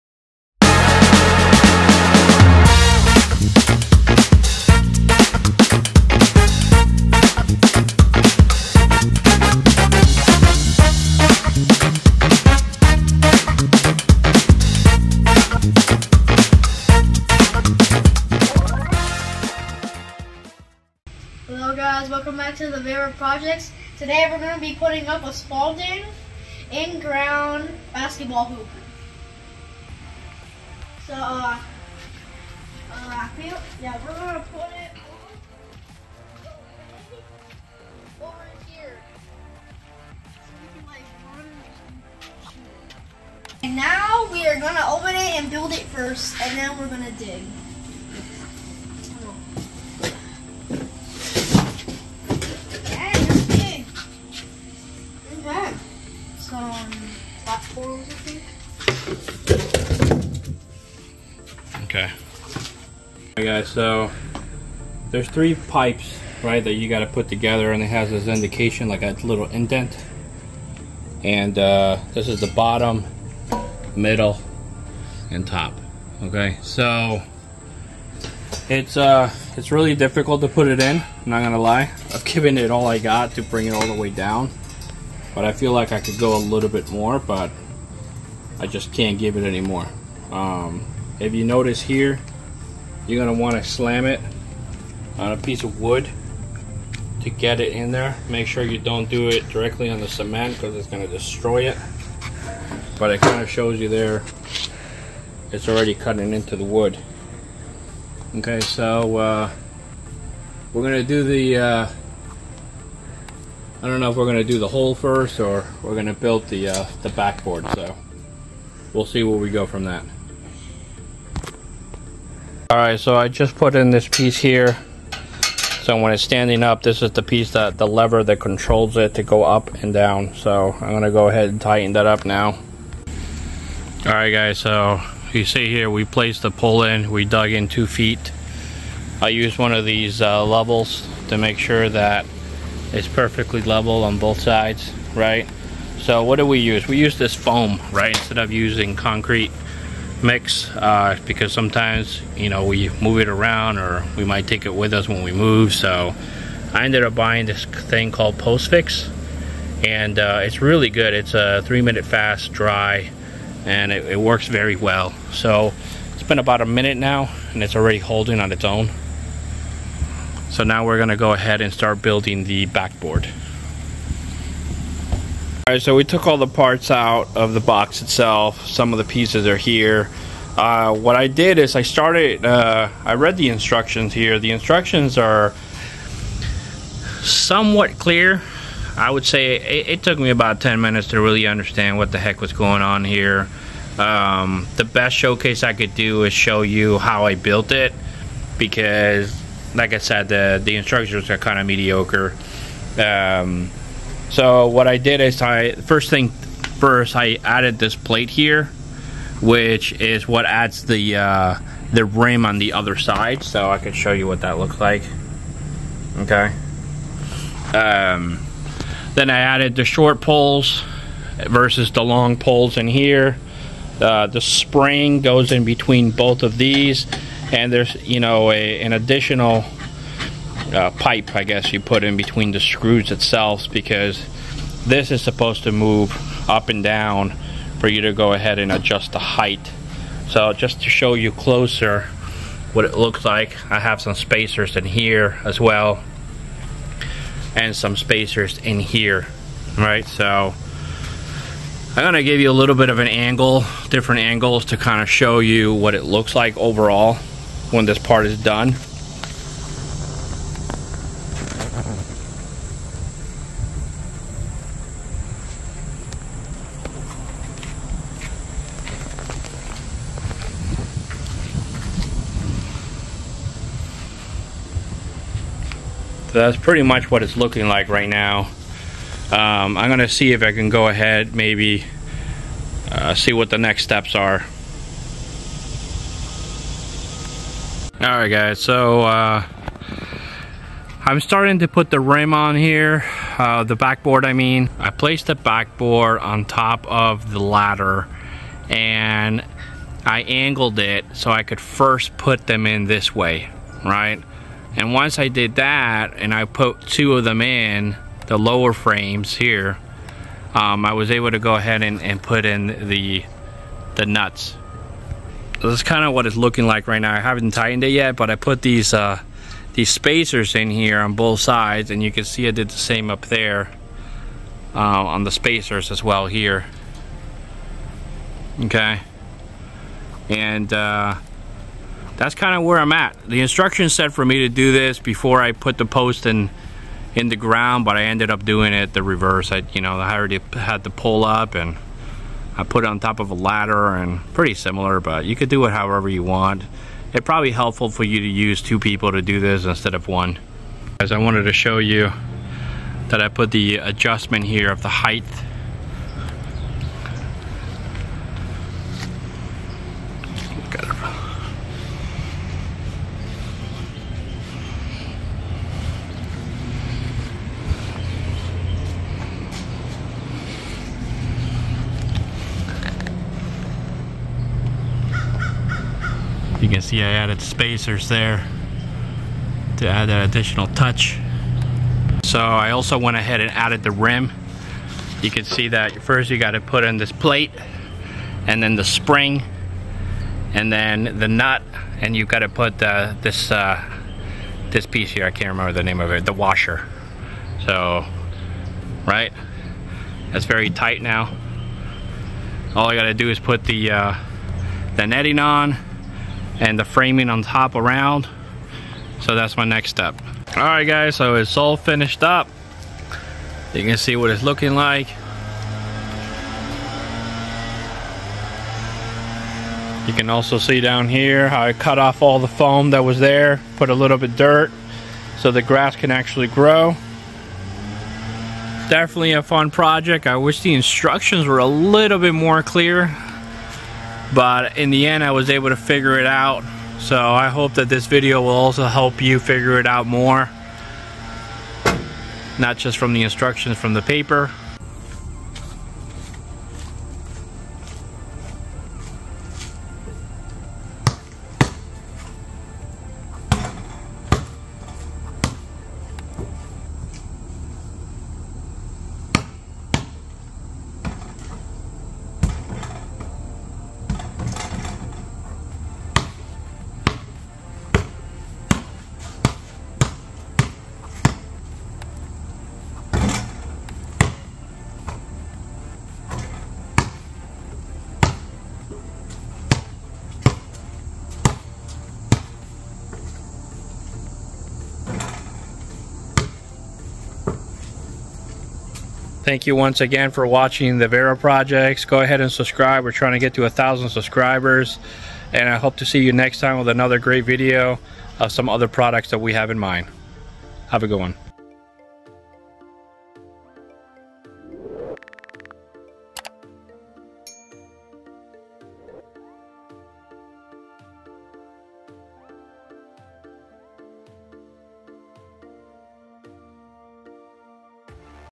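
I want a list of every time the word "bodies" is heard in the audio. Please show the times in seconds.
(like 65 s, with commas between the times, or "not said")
not said.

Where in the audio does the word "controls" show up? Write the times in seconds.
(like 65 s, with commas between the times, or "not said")
128 s.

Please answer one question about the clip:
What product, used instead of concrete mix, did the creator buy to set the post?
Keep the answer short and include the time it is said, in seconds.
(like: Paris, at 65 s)
Postfix, at 158 s.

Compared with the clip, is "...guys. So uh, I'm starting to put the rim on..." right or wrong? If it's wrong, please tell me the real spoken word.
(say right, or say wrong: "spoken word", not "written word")
right.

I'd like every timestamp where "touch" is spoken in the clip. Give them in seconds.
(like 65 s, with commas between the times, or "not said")
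380 s.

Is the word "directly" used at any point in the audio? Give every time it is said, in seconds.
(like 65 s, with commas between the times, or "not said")
99 s.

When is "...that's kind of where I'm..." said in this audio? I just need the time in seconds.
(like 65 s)
332 s.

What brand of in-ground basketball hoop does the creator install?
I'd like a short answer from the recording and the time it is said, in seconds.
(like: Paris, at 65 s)
Spalding, at 25 s.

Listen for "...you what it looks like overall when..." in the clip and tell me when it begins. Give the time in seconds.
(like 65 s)
255 s.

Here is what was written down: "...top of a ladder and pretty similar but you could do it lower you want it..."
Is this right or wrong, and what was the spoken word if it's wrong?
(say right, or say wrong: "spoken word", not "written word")
wrong: "however", not "lower".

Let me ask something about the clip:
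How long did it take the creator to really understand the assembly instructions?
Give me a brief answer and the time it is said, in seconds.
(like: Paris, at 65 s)
10 minutes, at 190 s.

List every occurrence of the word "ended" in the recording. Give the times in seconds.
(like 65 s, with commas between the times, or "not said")
156 s, 338 s.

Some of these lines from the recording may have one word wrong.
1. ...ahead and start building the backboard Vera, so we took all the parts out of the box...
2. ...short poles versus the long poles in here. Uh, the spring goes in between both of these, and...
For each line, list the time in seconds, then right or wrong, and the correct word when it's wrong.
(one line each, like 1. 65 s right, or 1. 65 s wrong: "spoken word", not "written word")
1. 171 s wrong: "Alright", not "Vera"
2. 219 s right.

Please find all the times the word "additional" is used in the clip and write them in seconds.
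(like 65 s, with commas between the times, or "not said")
228 s, 380 s.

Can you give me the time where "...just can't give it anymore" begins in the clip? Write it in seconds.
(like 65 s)
88 s.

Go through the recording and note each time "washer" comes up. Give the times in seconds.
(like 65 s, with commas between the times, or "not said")
396 s.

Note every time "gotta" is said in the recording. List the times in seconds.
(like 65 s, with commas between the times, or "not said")
402 s.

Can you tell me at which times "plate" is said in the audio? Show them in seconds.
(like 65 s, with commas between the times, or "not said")
207 s, 387 s.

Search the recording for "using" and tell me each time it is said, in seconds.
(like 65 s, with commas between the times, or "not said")
148 s.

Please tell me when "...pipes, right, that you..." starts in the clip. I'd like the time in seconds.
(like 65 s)
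65 s.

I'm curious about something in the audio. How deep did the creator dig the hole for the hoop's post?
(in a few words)
2 feet.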